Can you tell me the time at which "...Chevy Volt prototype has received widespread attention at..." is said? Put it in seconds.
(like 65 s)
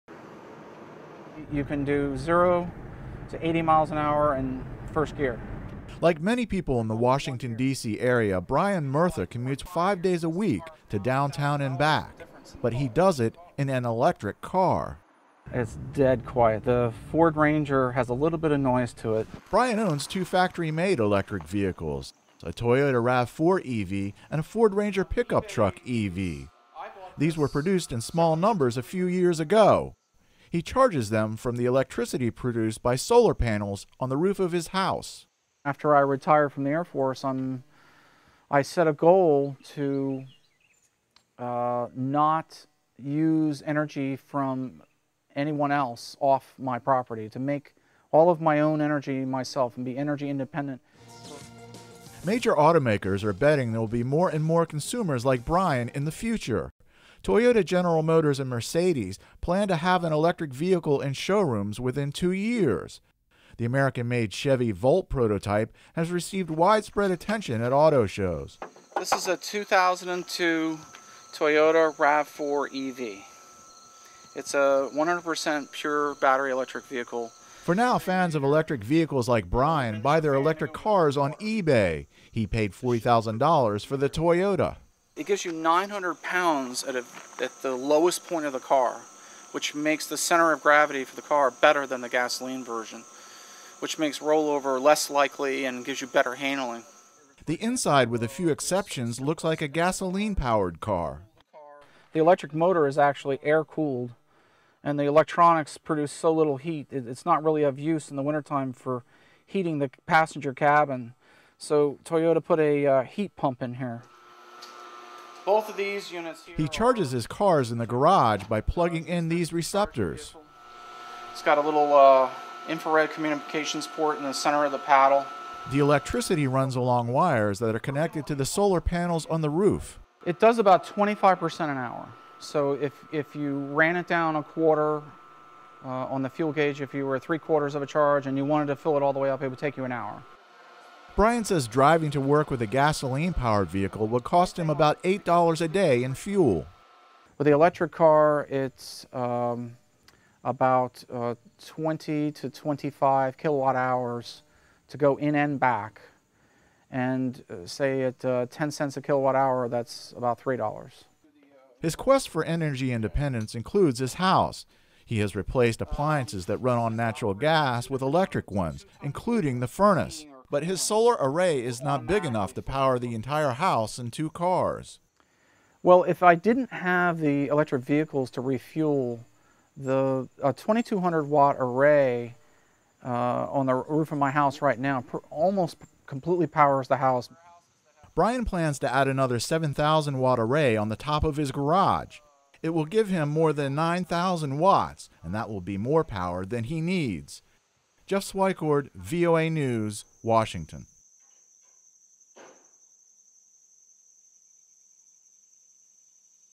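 64 s.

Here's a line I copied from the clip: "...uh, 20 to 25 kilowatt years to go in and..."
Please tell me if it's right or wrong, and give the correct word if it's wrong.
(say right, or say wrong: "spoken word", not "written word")
wrong: "hours", not "years".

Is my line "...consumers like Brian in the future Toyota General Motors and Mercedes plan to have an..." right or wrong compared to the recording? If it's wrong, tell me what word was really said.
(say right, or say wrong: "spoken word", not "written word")
right.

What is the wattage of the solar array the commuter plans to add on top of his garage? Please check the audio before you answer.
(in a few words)
7,000 watts.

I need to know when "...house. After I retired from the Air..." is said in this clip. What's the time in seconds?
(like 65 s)
34 s.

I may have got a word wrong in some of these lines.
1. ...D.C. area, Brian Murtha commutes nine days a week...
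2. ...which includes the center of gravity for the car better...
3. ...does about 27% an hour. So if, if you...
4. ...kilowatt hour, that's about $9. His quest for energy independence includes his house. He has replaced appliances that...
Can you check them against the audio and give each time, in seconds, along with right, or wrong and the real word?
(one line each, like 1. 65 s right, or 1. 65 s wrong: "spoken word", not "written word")
1. 7 s wrong: "five", not "nine"
2. 89 s wrong: "makes", not "includes"
3. 130 s wrong: "25", not "27"
4. 159 s wrong: "3", not "9".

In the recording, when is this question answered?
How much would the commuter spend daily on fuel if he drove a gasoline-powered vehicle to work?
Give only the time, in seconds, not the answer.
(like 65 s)
145 s.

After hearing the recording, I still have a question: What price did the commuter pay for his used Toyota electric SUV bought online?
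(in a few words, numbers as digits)
$40,000.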